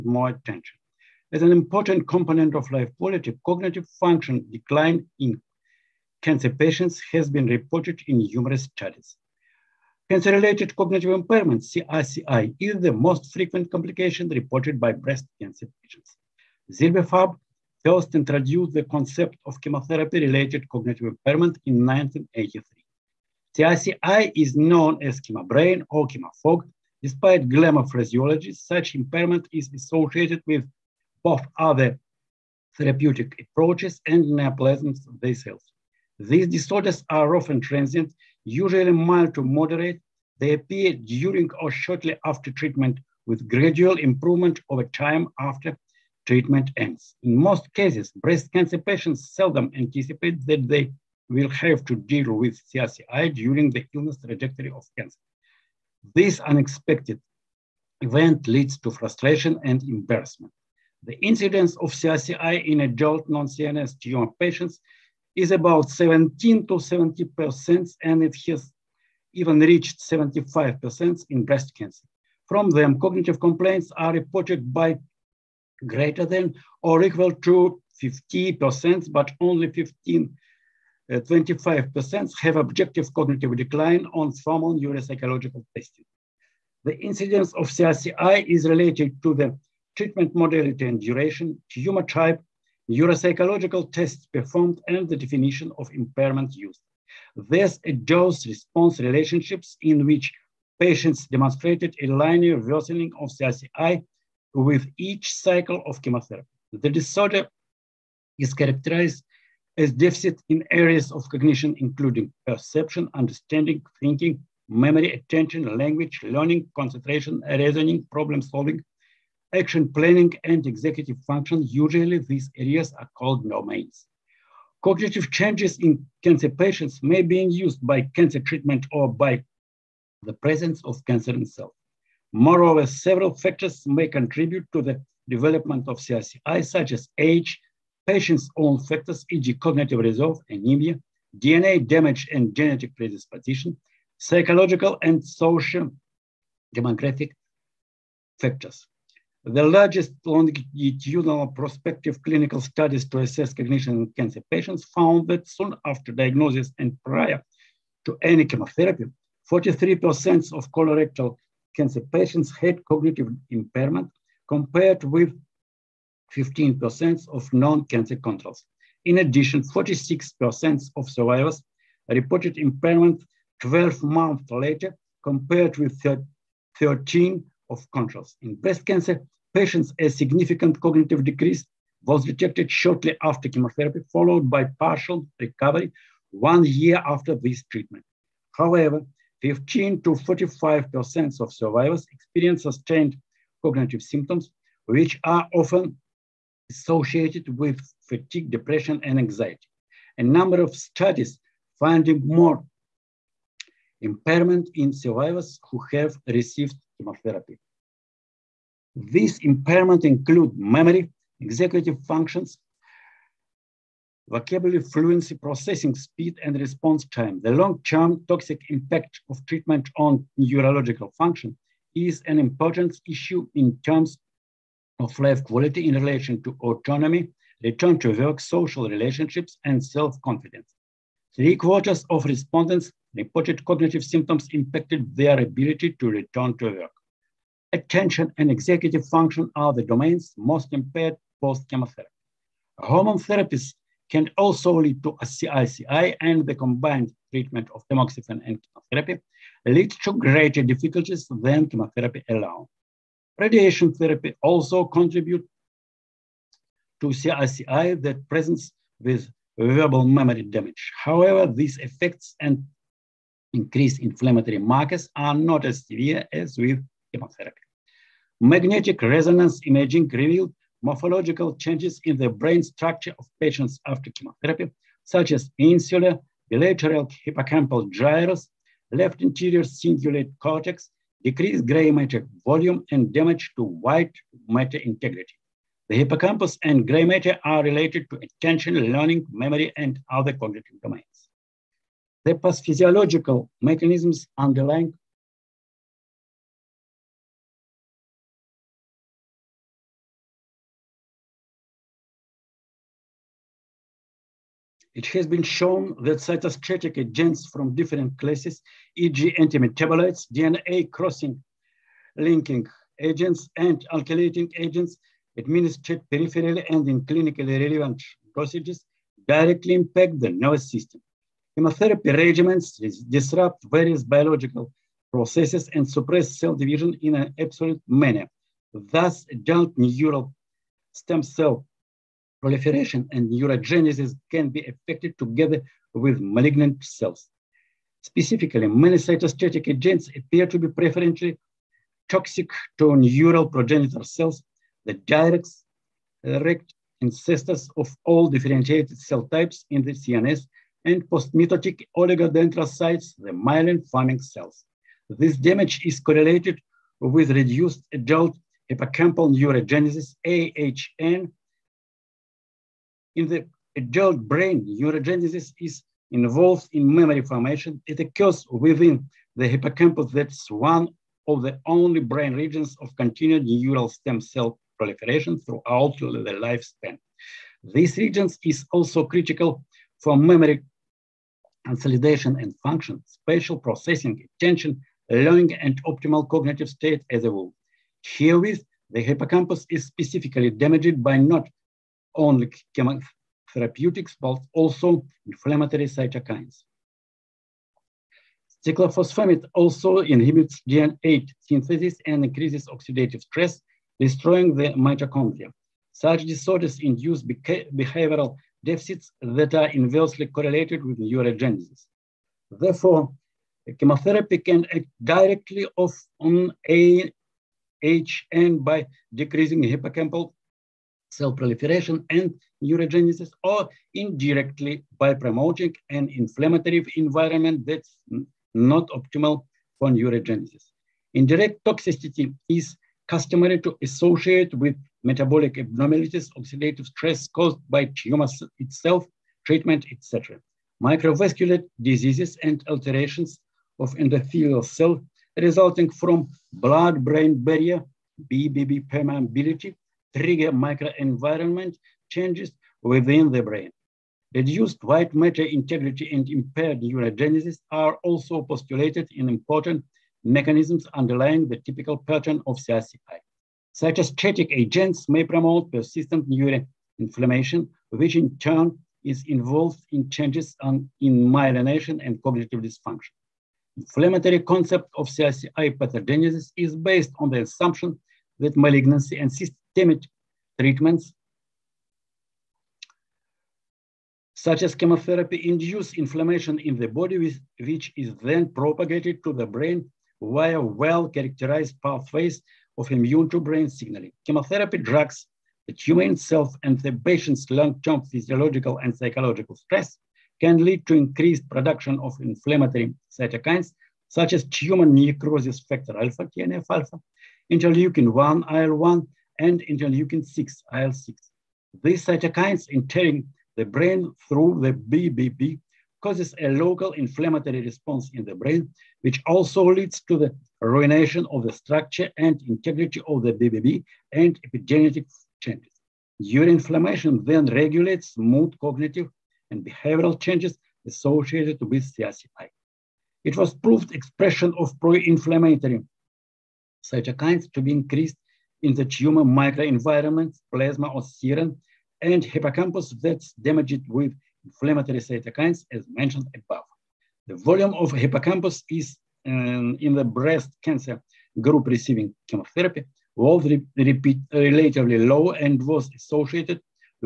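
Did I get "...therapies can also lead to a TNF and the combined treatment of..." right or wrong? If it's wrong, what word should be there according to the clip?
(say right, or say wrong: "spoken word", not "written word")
wrong: "CRCI", not "TNF".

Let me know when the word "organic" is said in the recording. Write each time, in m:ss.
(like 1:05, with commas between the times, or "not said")
not said.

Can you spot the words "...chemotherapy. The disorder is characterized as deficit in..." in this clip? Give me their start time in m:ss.
1:46.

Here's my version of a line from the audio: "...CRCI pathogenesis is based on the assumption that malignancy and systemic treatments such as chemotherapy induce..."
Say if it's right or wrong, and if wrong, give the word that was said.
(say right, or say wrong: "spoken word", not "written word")
right.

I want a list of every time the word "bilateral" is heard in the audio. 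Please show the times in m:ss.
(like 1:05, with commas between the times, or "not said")
4:36.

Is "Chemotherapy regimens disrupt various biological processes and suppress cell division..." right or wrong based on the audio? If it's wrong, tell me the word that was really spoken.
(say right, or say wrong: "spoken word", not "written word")
right.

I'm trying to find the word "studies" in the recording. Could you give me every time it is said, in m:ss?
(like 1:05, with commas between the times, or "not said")
0:08, 2:32, 3:20.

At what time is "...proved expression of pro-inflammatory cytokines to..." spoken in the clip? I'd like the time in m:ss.
8:53.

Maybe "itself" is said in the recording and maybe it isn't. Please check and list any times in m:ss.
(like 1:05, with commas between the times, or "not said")
2:11, 7:18.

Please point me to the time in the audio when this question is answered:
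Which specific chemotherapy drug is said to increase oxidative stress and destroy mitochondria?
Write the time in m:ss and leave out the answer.
6:38.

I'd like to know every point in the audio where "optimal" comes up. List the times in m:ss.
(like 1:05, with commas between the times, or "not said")
6:25, 7:08.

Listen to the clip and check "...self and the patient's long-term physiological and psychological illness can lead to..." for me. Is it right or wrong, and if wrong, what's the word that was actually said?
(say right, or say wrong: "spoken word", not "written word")
wrong: "stress", not "illness".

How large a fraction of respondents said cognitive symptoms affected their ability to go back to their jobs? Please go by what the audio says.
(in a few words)
Three quarters.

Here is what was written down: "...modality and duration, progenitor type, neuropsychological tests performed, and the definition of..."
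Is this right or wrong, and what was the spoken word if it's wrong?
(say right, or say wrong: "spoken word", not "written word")
wrong: "tumor", not "progenitor".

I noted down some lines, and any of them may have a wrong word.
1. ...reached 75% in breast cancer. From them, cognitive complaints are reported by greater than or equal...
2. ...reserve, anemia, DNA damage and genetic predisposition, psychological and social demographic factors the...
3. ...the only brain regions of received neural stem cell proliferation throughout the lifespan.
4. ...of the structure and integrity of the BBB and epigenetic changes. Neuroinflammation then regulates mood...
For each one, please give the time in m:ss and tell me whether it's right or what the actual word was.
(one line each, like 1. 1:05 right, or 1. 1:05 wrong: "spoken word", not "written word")
1. 1:09 right
2. 2:19 right
3. 6:11 wrong: "continued", not "received"
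4. 8:41 right.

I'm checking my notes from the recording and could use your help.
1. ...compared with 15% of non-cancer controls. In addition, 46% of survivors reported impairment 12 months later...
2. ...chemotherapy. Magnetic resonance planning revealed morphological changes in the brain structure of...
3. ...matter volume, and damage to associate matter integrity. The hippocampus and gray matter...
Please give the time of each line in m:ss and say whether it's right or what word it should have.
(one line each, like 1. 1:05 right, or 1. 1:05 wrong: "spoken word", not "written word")
1. 2:44 right
2. 4:27 wrong: "imaging", not "planning"
3. 4:41 wrong: "white", not "associate".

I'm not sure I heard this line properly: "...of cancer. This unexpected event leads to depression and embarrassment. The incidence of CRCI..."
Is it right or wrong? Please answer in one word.
wrong.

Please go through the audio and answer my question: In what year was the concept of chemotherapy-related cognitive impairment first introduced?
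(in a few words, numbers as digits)
1983.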